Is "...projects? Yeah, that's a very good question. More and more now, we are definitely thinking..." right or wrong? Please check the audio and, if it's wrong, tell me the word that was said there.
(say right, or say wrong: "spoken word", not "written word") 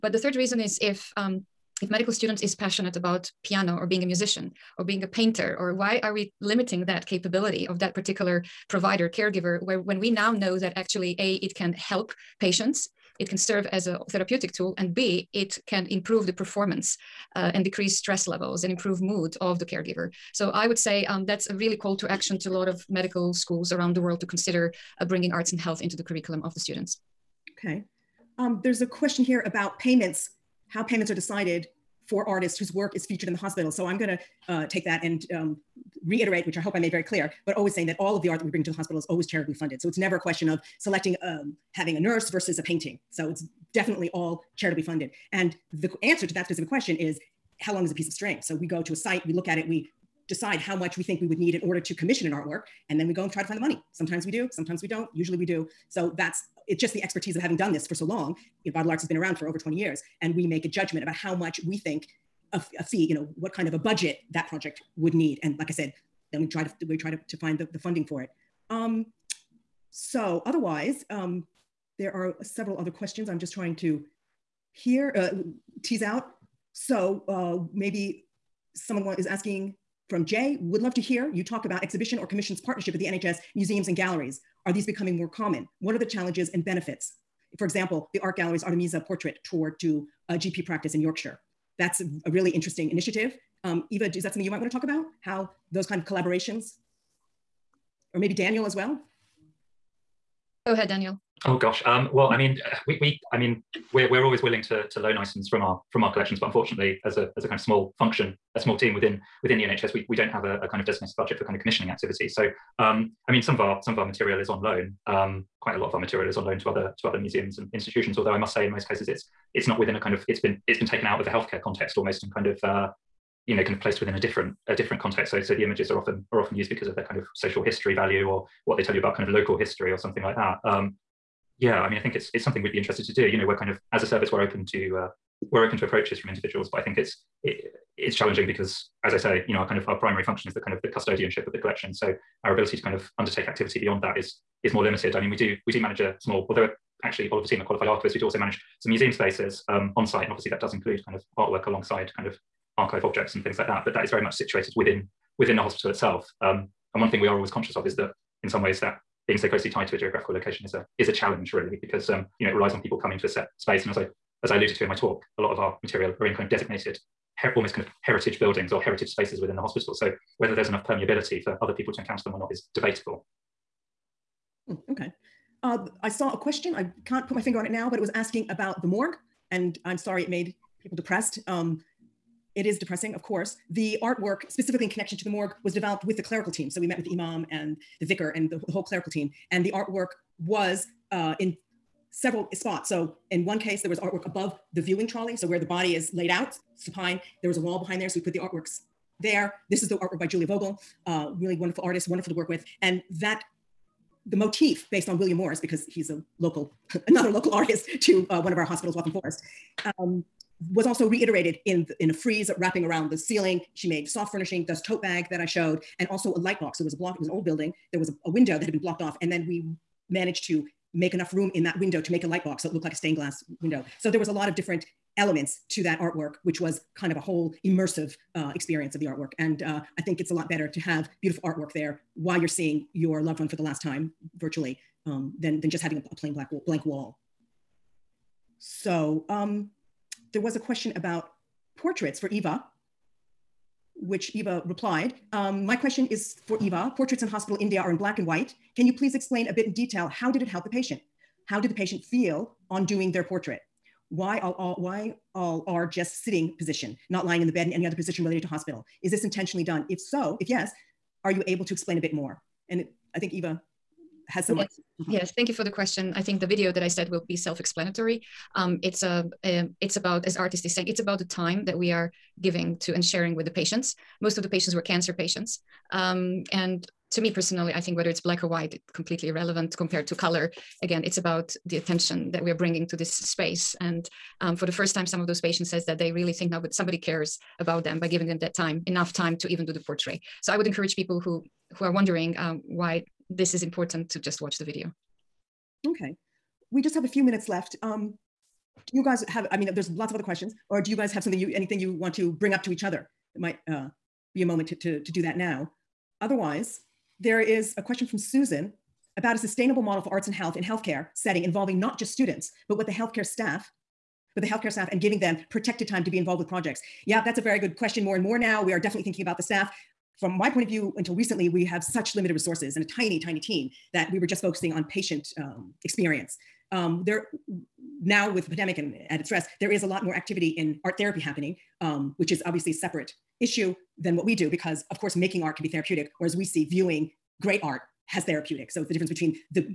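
right.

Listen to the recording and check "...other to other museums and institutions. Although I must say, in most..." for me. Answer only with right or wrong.
right.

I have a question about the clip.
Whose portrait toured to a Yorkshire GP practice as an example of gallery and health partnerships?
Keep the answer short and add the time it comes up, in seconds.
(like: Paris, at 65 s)
Artemisia, at 88 s.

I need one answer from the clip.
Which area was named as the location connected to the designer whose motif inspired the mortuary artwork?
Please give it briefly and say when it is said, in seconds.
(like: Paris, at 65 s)
Waltham Forest, at 208 s.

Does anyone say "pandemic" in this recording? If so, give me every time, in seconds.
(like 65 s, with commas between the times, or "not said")
328 s.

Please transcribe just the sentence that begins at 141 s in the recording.
So our ability to kind of undertake activity beyond that is is more limited.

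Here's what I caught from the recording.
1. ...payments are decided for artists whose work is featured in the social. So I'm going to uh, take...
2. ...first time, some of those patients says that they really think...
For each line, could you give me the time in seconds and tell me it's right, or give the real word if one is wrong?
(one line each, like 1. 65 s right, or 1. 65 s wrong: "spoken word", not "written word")
1. 30 s wrong: "hospital", not "social"
2. 284 s right.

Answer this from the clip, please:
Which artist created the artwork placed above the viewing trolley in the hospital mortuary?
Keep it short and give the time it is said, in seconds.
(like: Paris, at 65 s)
Julia Vogl, at 200 s.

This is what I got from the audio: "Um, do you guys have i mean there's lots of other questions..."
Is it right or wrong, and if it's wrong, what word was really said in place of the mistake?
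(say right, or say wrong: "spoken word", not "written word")
right.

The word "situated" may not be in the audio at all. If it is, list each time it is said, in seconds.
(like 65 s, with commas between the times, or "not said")
154 s.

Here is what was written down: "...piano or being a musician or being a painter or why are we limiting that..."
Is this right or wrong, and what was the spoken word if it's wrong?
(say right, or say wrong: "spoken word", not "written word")
right.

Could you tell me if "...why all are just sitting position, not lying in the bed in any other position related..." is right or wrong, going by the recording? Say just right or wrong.
right.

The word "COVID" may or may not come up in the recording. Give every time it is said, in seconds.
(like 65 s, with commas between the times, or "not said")
not said.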